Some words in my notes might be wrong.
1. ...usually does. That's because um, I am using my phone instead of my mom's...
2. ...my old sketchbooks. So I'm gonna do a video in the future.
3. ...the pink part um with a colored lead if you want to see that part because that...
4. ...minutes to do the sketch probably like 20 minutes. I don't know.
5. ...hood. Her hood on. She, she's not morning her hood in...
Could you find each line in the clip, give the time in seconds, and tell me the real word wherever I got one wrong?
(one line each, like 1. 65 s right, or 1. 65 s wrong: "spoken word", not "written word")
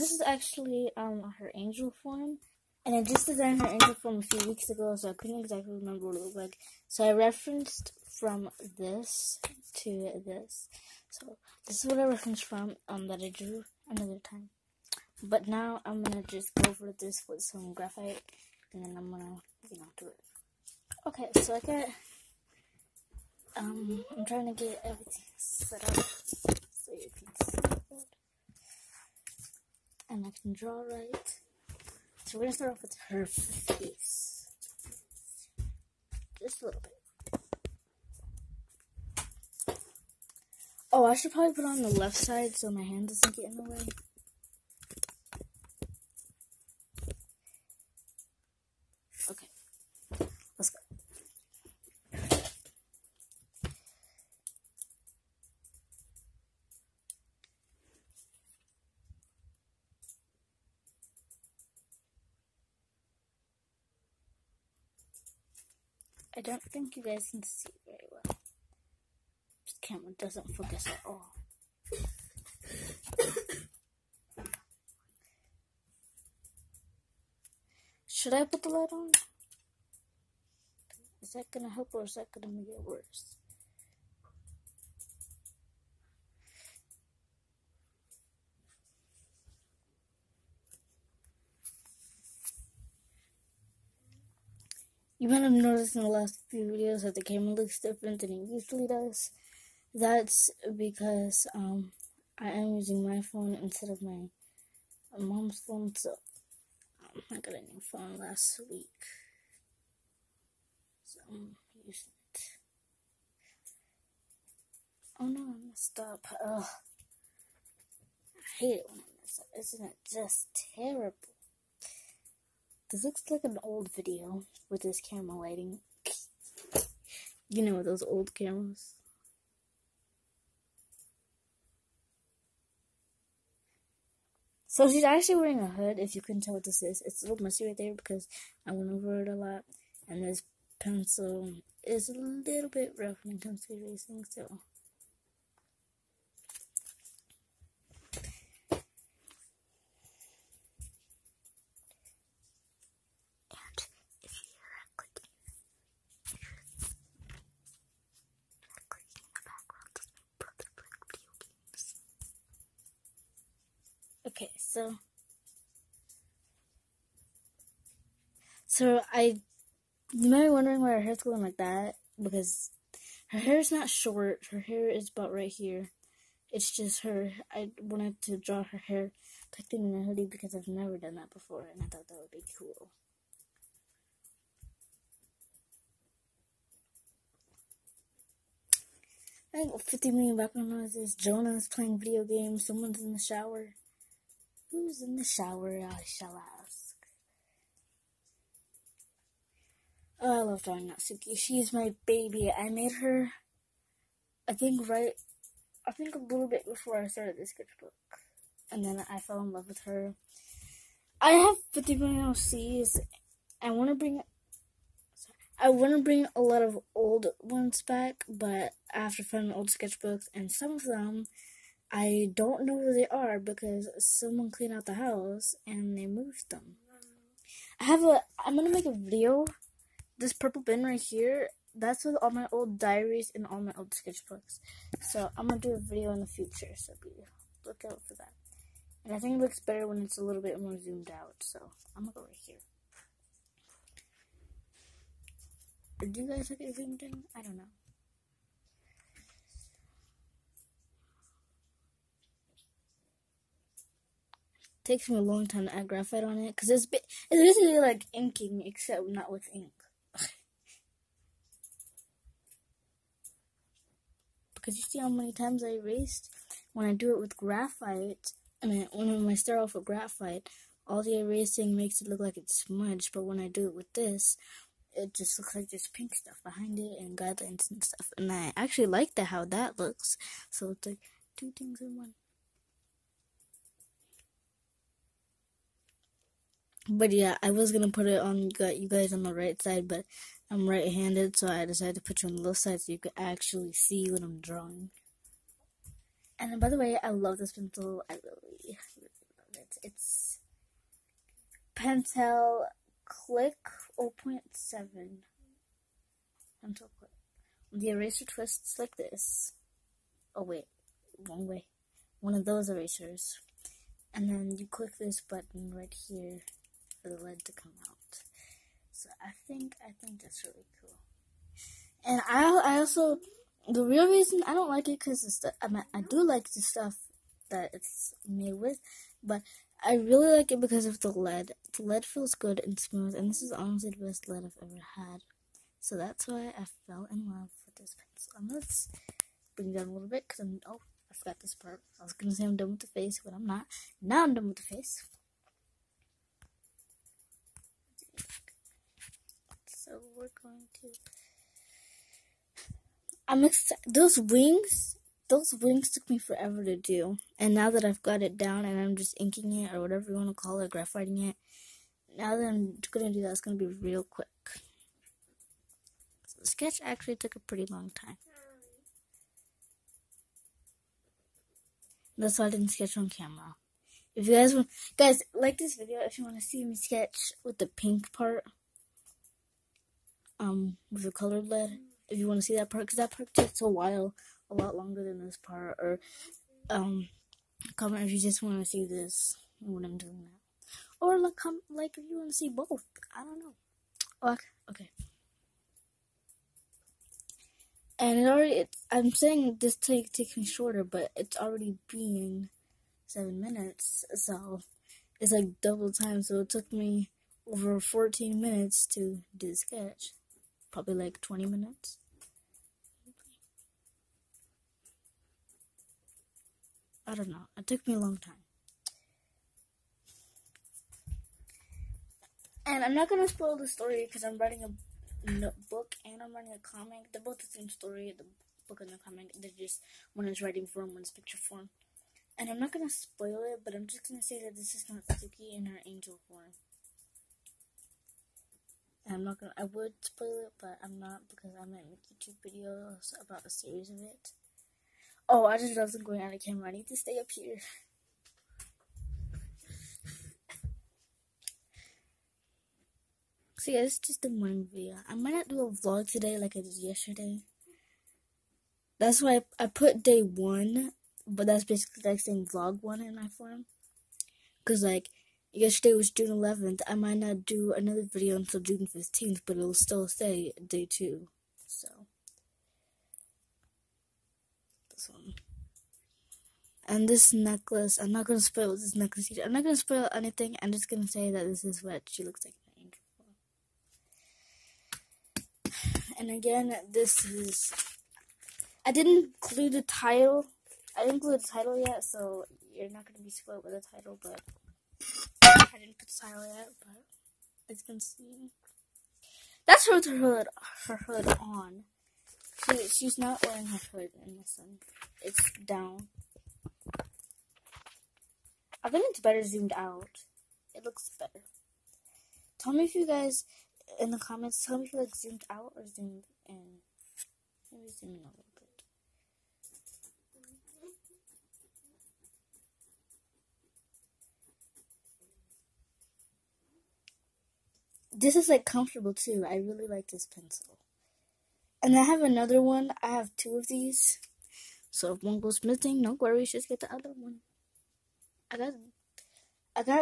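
1. 98 s right
2. 233 s right
3. 377 s right
4. 408 s right
5. 500 s wrong: "wearing", not "morning".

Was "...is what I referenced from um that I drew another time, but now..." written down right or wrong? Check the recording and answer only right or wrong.
right.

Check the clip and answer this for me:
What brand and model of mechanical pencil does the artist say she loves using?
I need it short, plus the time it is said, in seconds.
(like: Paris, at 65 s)
Pentel Click 0.7, at 301 s.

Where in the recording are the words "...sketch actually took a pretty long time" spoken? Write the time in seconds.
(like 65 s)
366 s.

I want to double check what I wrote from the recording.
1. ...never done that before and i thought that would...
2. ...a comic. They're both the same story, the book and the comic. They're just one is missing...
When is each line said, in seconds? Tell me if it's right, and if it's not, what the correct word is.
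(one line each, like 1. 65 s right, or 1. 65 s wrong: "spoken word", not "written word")
1. 180 s right
2. 426 s wrong: "writing", not "missing".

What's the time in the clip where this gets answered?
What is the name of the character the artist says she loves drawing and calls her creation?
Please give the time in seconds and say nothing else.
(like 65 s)
200 s.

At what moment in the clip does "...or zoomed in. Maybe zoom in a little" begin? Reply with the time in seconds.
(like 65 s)
515 s.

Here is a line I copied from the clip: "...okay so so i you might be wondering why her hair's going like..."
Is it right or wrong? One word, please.
right.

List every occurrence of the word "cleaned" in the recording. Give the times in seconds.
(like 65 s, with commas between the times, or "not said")
224 s.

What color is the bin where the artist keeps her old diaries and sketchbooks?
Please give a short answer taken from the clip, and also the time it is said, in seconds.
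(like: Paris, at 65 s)
Purple, at 230 s.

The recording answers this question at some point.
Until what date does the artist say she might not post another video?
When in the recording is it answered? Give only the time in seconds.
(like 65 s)
468 s.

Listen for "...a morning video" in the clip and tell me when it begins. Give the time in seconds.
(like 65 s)
454 s.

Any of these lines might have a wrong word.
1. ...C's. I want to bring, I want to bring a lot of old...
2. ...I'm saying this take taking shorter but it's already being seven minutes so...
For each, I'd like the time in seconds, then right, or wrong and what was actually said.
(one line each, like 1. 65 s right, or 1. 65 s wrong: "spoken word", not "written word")
1. 212 s right
2. 398 s right.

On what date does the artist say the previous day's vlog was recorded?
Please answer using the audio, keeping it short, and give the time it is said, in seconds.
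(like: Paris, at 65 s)
June 11th, at 466 s.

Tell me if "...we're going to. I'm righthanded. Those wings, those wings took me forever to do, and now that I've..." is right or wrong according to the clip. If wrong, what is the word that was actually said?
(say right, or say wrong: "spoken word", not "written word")
wrong: "excited", not "righthanded".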